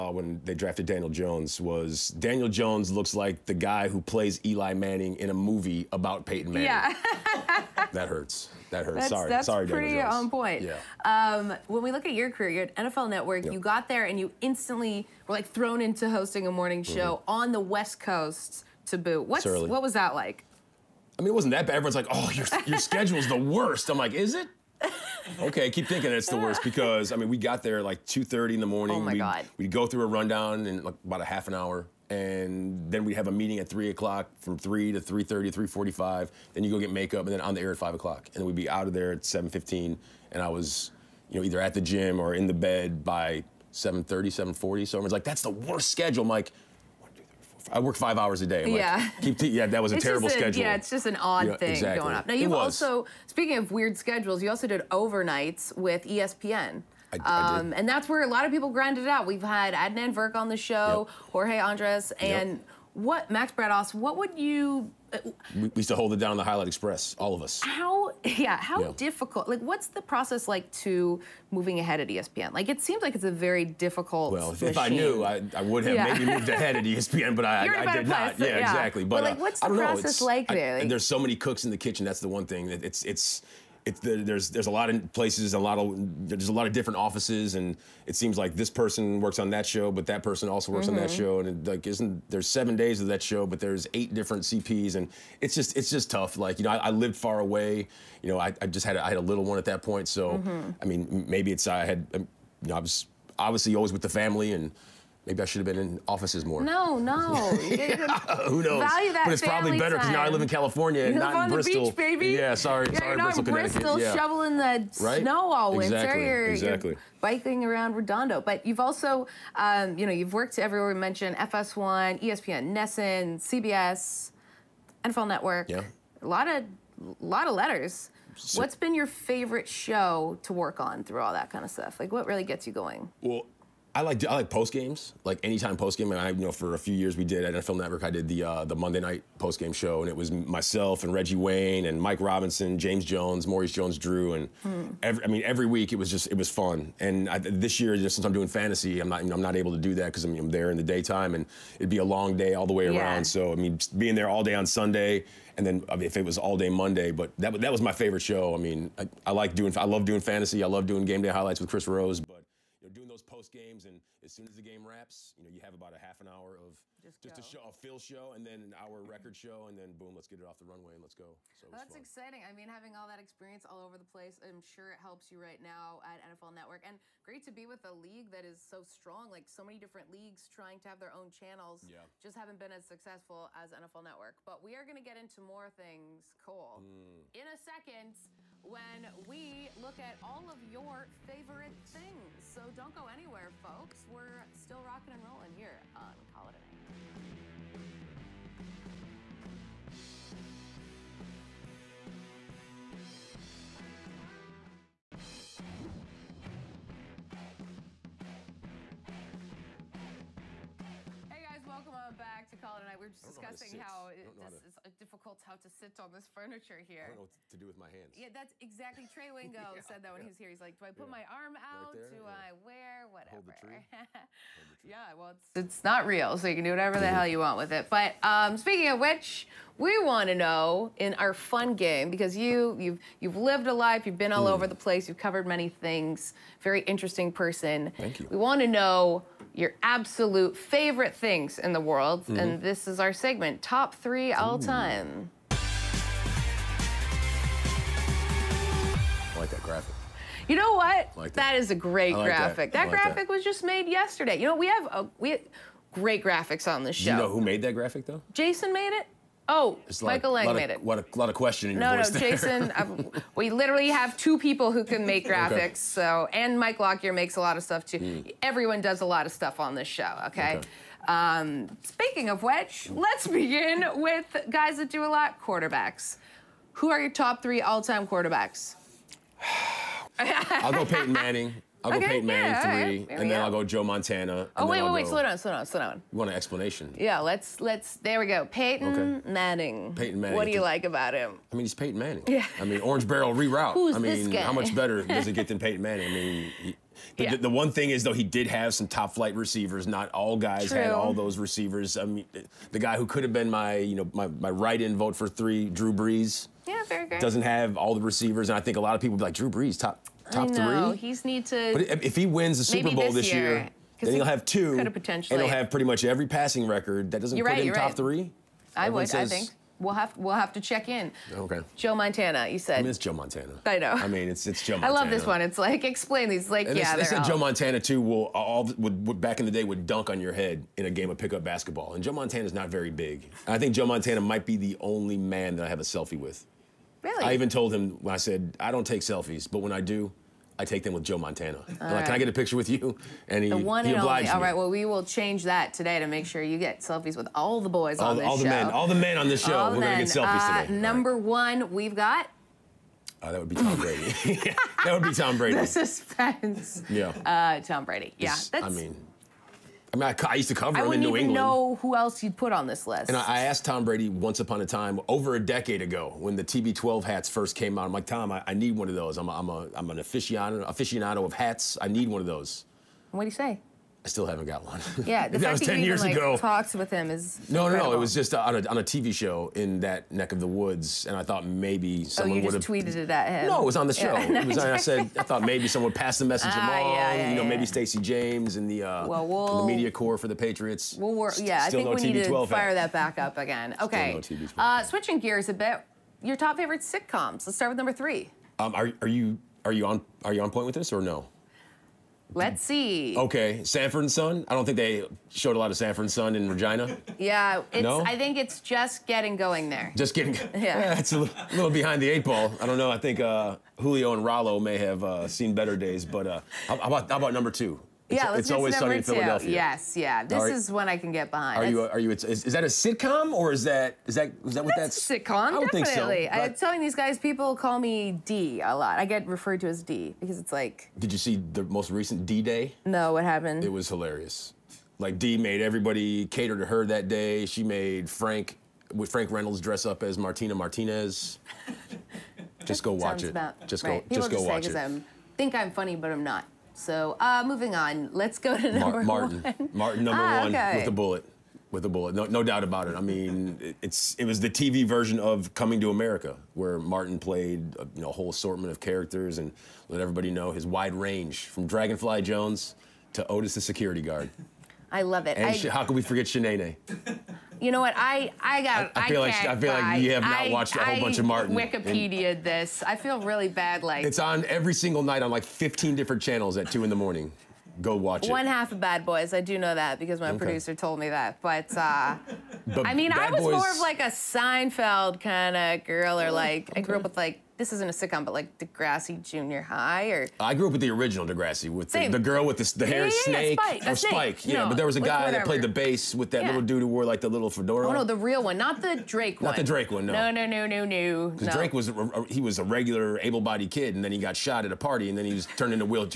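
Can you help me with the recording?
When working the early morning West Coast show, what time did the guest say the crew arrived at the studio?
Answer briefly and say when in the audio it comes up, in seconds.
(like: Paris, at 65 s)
2:30 in the morning, at 28 s.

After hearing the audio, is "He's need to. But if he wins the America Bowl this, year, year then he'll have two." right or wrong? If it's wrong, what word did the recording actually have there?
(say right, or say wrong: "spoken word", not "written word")
wrong: "Super", not "America".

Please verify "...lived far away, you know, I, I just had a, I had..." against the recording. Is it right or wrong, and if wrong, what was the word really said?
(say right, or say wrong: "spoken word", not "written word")
right.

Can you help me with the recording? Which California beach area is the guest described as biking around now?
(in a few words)
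Redondo.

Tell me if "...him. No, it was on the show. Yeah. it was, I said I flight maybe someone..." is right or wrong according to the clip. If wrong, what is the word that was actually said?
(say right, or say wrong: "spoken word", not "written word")
wrong: "thought", not "flight".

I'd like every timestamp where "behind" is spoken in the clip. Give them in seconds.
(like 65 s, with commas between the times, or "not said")
411 s, 421 s.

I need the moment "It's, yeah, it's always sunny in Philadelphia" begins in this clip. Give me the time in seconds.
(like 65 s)
418 s.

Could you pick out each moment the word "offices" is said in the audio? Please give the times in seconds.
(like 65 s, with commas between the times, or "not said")
86 s, 106 s.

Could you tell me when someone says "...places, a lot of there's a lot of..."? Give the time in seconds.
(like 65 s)
85 s.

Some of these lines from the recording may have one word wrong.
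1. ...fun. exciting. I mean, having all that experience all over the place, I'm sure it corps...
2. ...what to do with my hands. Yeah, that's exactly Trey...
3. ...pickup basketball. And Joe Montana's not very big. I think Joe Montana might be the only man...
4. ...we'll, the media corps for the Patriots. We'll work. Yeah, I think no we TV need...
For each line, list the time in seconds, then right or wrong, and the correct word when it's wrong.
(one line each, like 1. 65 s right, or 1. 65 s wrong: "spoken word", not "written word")
1. 171 s wrong: "helps", not "corps"
2. 217 s right
3. 331 s right
4. 389 s right.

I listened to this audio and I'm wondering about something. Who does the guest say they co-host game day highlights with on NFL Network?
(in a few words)
Chris Rose.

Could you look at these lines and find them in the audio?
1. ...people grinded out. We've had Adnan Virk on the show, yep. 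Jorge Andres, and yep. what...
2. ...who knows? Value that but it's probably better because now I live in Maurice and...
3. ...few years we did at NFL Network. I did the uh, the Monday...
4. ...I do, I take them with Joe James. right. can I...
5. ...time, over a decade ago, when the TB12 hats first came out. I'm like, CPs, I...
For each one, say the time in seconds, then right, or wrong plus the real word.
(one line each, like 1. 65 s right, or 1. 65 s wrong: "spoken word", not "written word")
1. 58 s right
2. 108 s wrong: "California", not "Maurice"
3. 136 s right
4. 339 s wrong: "Montana", not "James"
5. 364 s wrong: "Tom", not "CPs".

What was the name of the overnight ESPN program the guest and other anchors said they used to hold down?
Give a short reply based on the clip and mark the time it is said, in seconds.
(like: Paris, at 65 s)
Highlight Express, at 66 s.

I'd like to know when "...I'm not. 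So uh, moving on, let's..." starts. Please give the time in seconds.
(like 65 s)
446 s.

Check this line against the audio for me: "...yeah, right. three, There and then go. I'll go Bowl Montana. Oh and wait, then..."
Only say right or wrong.
wrong.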